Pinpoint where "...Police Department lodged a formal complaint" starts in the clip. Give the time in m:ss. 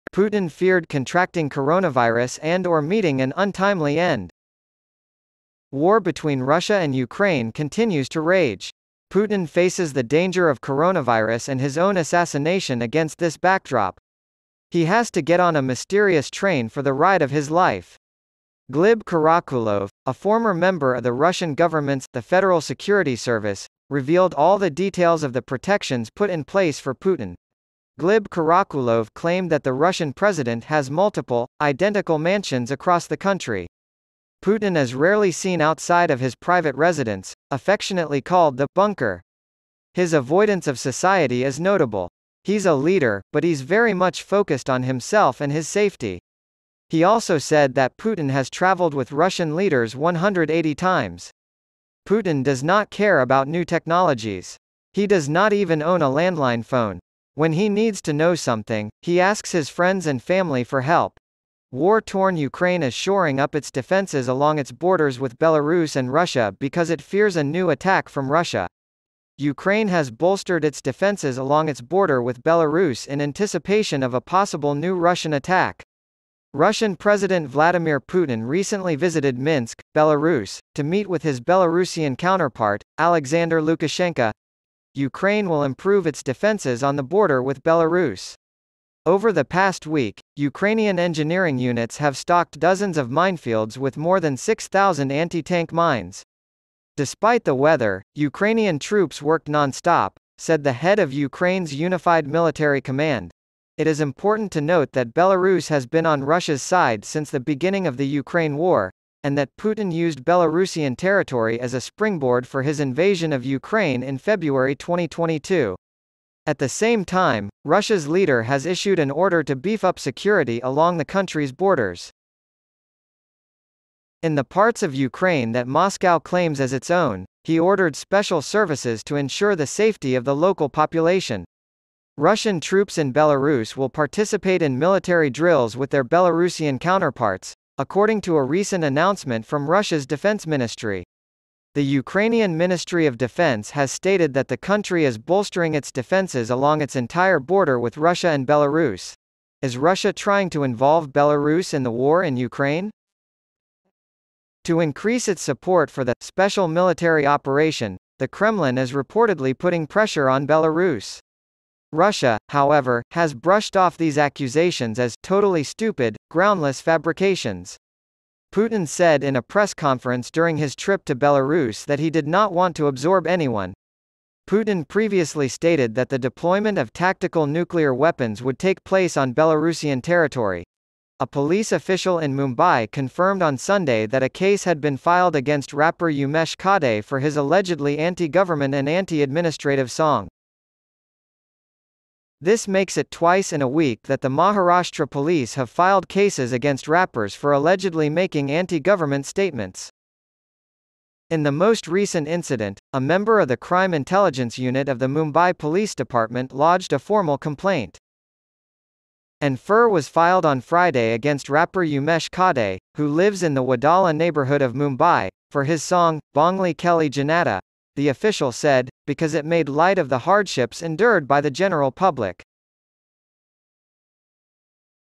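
3:25.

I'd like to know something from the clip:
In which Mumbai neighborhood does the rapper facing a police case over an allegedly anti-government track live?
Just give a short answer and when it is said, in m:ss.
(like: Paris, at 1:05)
Wadala, at 3:33.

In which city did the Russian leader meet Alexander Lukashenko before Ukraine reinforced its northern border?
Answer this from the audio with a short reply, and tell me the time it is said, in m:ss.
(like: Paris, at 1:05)
Minsk, at 1:19.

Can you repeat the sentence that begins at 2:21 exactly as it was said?
The Ukrainian Ministry of Defense has stated that the country is bolstering its defenses along its entire border with Russia and Belarus.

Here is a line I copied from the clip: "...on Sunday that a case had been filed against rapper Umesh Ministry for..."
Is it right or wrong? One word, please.
wrong.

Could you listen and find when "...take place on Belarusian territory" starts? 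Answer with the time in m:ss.
2:58.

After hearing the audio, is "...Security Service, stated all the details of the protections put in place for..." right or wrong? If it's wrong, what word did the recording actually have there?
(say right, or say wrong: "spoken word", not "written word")
wrong: "revealed", not "stated".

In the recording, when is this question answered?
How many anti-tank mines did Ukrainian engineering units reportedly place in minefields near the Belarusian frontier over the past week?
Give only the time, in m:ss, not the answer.
1:34.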